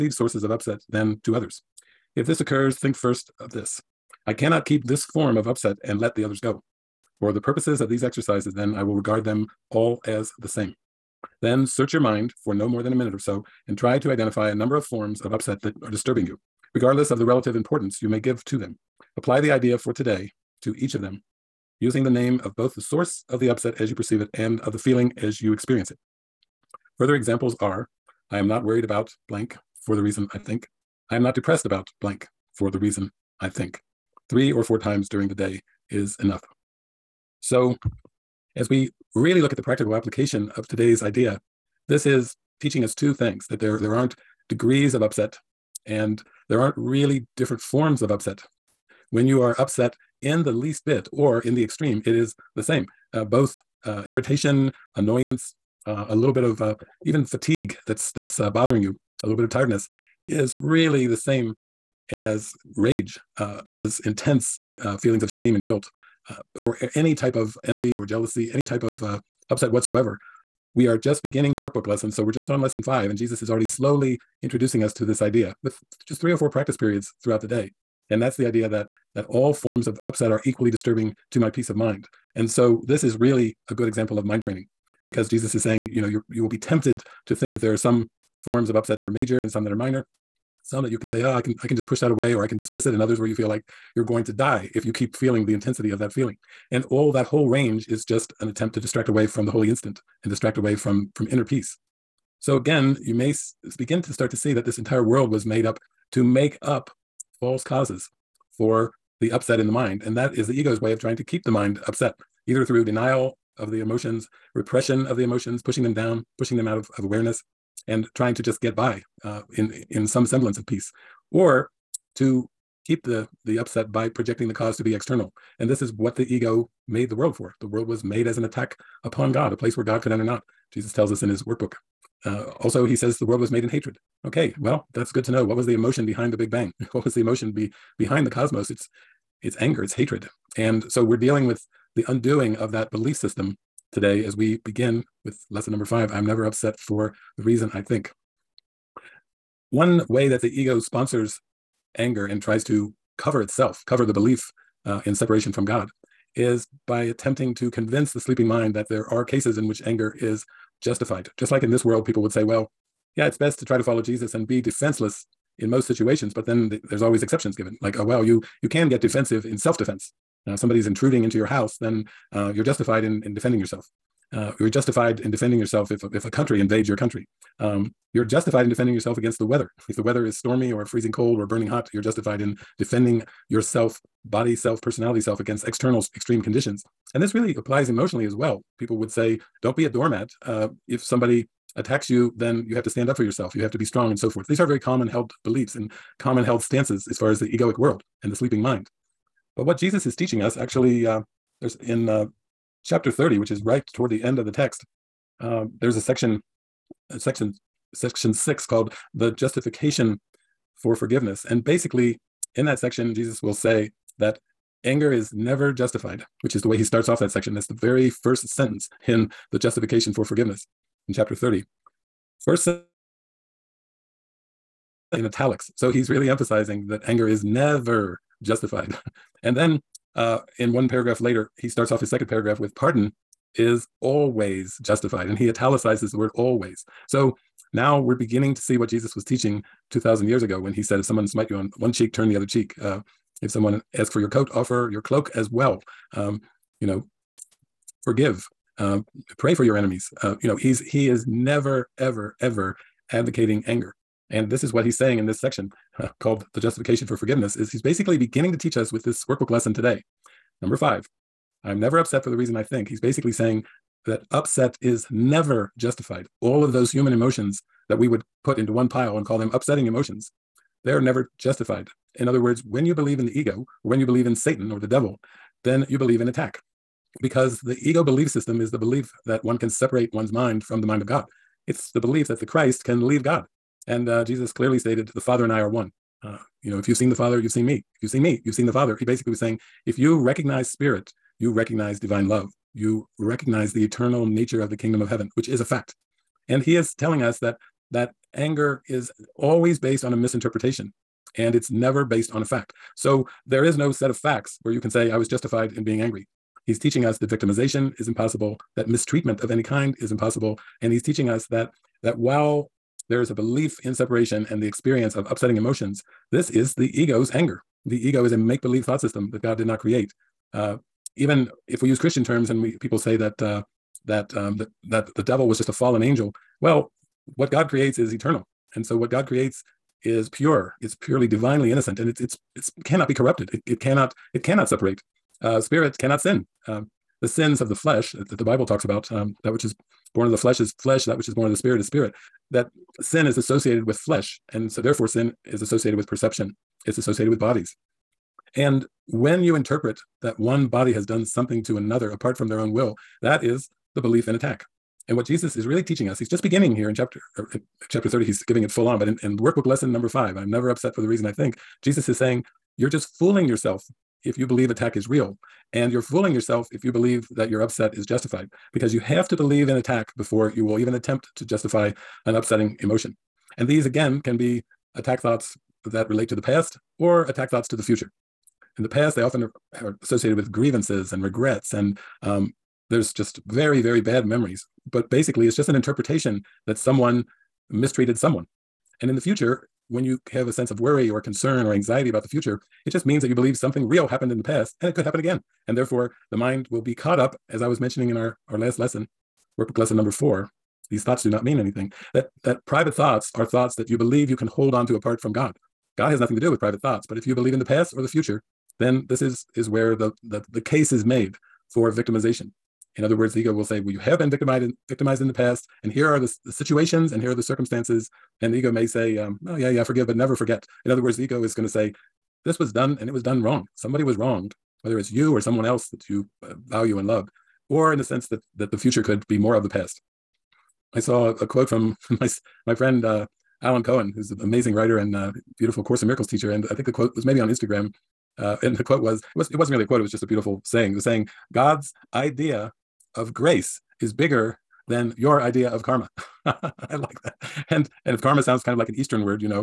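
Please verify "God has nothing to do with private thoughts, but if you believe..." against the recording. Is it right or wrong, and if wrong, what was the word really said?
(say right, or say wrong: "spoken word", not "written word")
right.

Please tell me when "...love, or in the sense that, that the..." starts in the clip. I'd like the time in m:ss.
7:07.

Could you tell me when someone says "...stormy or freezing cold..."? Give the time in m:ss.
3:00.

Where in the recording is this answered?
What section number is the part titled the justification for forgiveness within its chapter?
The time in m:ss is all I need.
3:27.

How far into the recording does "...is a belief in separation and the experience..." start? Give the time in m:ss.
5:13.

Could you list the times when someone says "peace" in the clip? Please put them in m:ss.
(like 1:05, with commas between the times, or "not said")
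1:21, 1:41, 2:00.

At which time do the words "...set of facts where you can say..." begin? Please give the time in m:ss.
5:03.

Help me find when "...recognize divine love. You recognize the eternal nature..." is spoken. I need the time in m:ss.
4:51.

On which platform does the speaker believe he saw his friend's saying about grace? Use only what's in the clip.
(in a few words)
Instagram.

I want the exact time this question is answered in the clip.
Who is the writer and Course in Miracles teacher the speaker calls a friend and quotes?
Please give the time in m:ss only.
7:13.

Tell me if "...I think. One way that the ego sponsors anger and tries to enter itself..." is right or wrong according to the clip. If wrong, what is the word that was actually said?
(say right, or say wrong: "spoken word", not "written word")
wrong: "cover", not "enter".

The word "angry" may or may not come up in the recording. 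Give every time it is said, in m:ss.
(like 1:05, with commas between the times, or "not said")
5:05.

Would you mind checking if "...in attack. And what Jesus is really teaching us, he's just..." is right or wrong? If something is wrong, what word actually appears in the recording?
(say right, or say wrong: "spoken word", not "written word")
right.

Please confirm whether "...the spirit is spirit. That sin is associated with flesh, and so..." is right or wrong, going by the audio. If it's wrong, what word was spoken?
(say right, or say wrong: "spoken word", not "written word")
right.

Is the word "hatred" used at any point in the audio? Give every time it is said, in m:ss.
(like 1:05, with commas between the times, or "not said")
2:13, 2:19.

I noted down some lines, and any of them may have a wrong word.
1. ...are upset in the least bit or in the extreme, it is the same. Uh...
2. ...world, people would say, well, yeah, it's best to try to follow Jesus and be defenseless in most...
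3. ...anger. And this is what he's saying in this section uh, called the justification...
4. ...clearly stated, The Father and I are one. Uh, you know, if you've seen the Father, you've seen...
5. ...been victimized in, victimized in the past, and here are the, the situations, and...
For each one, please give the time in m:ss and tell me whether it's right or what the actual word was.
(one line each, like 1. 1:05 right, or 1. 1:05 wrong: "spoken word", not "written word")
1. 0:49 right
2. 2:41 right
3. 4:13 right
4. 4:44 right
5. 6:54 right.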